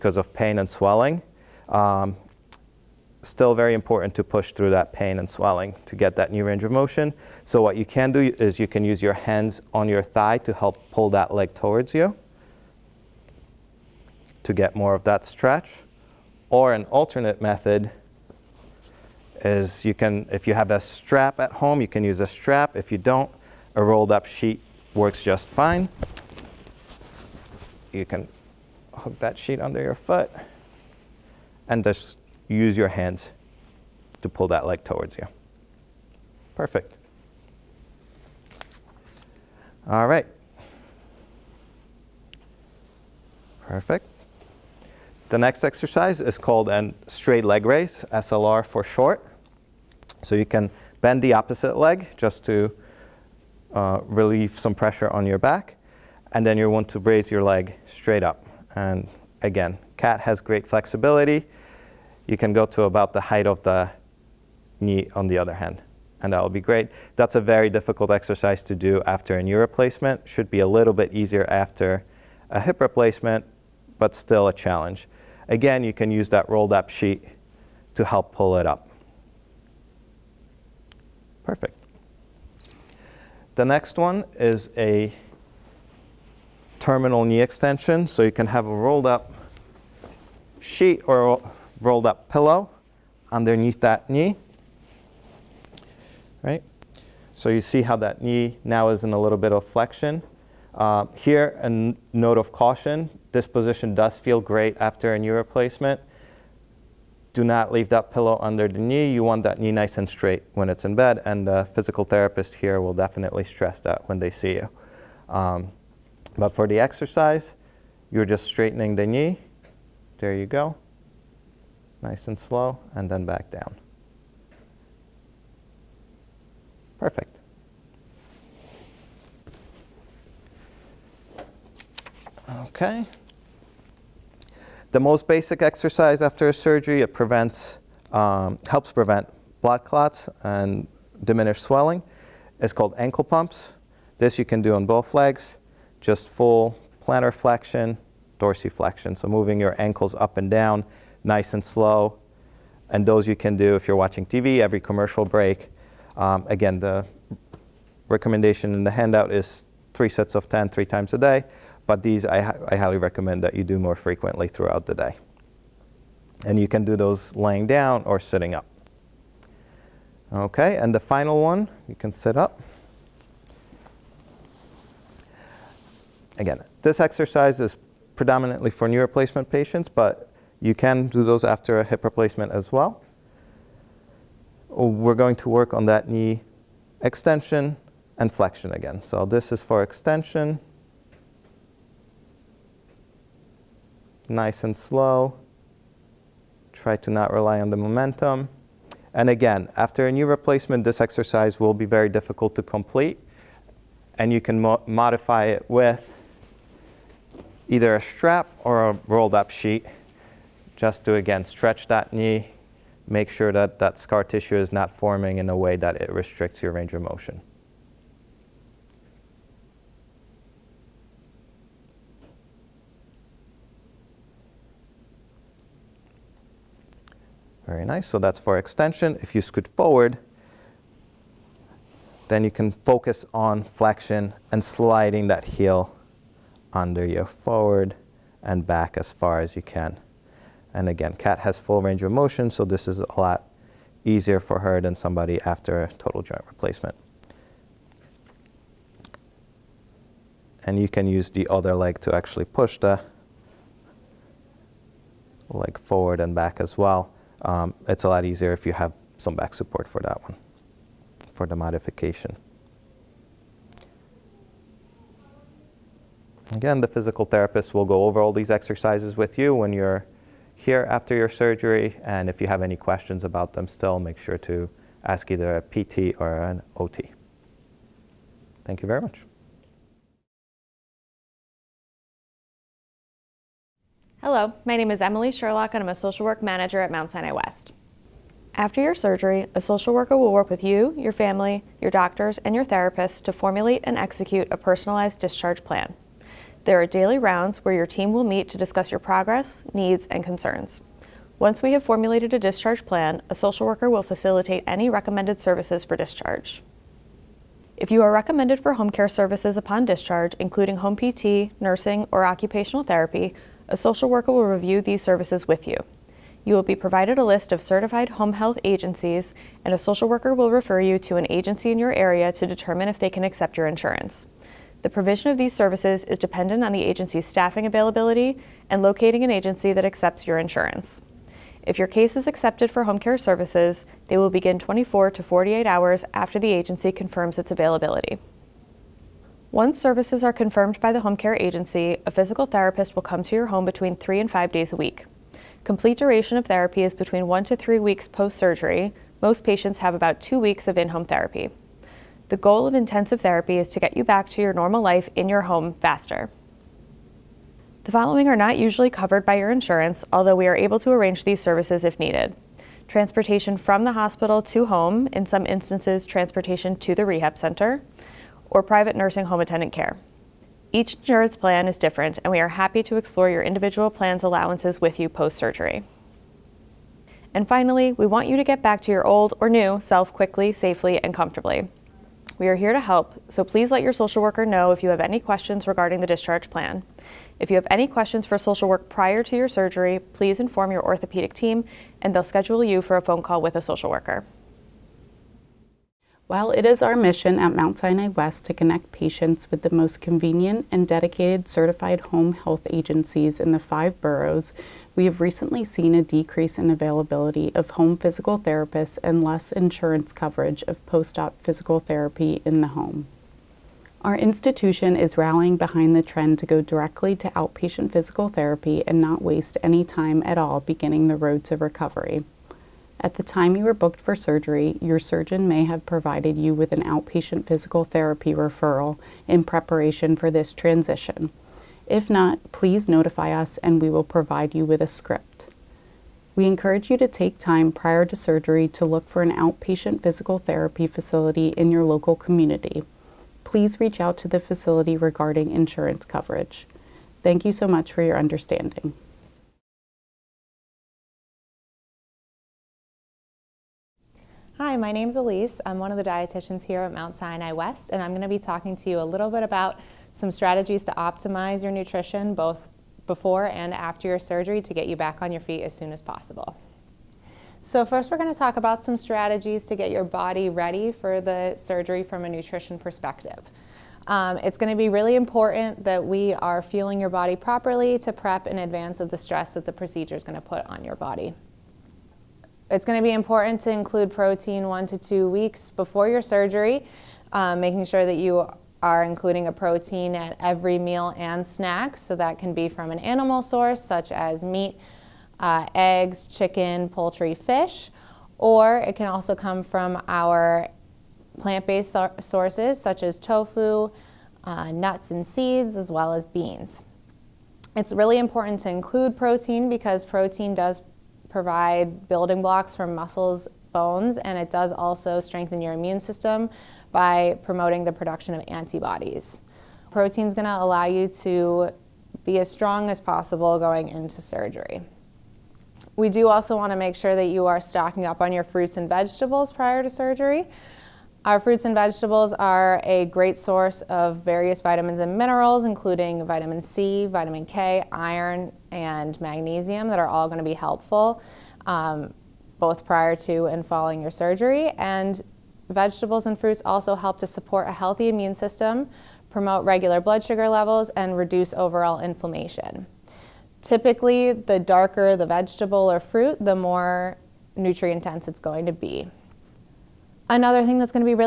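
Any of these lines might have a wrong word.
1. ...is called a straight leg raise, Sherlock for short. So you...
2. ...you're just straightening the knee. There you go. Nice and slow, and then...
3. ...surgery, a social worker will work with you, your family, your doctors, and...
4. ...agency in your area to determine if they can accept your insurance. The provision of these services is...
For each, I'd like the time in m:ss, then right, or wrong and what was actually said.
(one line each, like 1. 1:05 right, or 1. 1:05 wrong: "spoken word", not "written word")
1. 0:46 wrong: "SLR", not "Sherlock"
2. 1:58 right
3. 4:48 right
4. 5:21 right.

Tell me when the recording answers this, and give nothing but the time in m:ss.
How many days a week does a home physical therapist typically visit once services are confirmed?
5:43.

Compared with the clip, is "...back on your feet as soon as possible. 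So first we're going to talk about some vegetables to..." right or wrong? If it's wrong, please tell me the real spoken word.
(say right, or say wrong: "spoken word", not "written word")
wrong: "strategies", not "vegetables".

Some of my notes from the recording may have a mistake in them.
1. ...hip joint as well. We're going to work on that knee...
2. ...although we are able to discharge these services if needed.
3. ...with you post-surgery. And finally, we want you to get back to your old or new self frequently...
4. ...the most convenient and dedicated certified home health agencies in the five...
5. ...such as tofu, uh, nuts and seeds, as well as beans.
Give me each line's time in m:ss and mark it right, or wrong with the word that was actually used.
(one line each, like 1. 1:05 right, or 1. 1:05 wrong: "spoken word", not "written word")
1. 3:01 wrong: "replacement", not "joint"
2. 6:00 wrong: "arrange", not "discharge"
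3. 6:14 wrong: "quickly", not "frequently"
4. 6:39 right
5. 8:22 right.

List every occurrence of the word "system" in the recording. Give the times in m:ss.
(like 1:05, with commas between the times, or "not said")
8:35, 9:08.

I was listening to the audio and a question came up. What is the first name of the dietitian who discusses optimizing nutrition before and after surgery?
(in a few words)
Elise.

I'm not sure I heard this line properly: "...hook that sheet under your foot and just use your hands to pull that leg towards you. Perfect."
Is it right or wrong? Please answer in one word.
right.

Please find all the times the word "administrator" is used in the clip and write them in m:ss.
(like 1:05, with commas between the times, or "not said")
not said.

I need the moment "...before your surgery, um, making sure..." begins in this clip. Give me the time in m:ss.
8:05.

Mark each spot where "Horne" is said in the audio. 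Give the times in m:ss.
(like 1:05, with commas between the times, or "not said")
not said.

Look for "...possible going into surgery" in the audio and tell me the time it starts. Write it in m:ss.
8:42.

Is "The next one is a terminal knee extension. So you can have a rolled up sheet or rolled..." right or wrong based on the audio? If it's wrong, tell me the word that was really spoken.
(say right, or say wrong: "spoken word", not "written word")
right.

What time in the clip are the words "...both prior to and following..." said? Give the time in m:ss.
9:02.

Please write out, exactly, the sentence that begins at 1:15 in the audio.
Again, you can use that rolled up sheet to help pull it up.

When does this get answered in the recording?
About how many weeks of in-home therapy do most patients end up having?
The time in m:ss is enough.
5:49.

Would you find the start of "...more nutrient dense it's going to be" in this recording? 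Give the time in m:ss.
9:16.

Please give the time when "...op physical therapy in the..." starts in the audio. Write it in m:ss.
6:51.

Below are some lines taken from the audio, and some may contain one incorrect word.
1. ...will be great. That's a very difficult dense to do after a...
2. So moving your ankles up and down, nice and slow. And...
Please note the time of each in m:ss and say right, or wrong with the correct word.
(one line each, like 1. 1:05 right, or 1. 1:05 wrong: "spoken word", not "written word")
1. 1:06 wrong: "exercise", not "dense"
2. 2:29 right.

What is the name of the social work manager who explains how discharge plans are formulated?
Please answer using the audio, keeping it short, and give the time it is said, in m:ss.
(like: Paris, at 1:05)
Emily Sherlock, at 4:44.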